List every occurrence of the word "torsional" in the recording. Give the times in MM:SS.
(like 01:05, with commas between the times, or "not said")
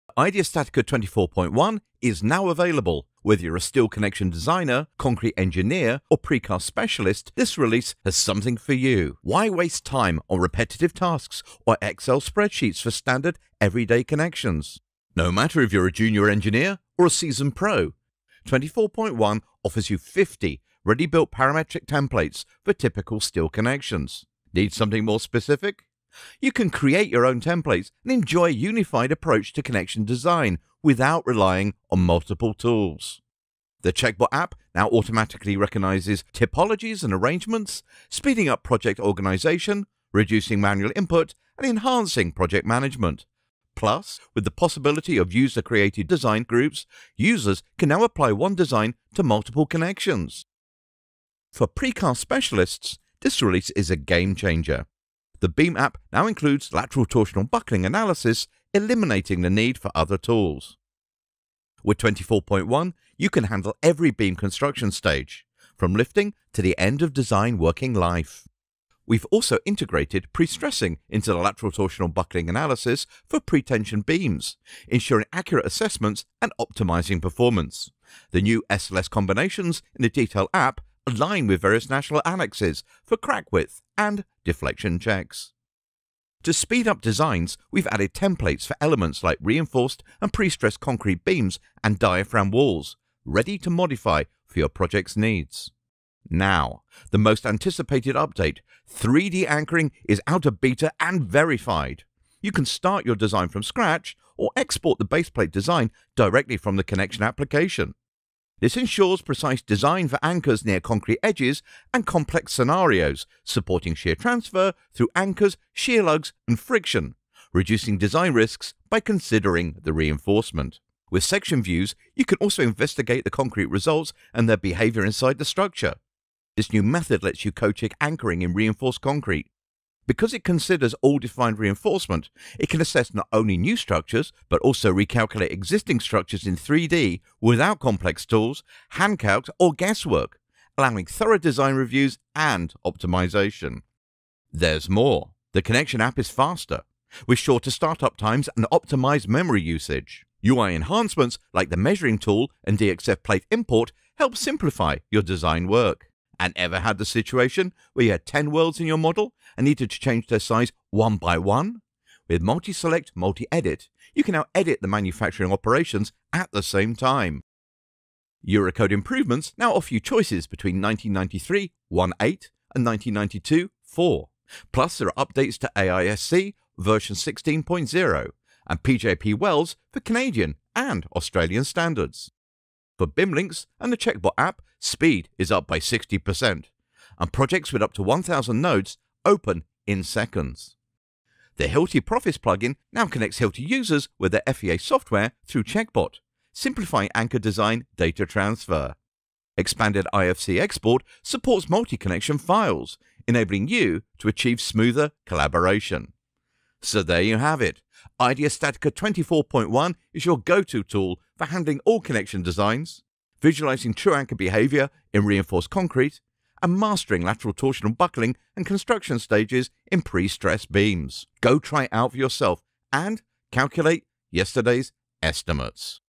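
00:57, 01:11, 03:37.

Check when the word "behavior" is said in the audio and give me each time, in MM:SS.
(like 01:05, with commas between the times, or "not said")
02:04, 03:34.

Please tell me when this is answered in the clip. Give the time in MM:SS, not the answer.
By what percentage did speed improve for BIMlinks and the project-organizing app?
03:05.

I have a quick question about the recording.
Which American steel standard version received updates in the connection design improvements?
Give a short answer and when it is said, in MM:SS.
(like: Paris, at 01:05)
AISC 16.0, at 02:55.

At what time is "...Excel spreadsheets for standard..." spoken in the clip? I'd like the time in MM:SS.
00:11.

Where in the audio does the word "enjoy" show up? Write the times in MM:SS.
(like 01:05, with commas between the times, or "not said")
00:28.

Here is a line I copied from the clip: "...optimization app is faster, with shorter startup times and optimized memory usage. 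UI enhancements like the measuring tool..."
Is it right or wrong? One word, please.
wrong.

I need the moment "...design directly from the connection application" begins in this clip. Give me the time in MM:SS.
01:45.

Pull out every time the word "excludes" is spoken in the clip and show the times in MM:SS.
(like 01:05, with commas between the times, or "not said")
not said.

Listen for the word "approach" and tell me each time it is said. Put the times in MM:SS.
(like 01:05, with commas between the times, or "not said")
00:29.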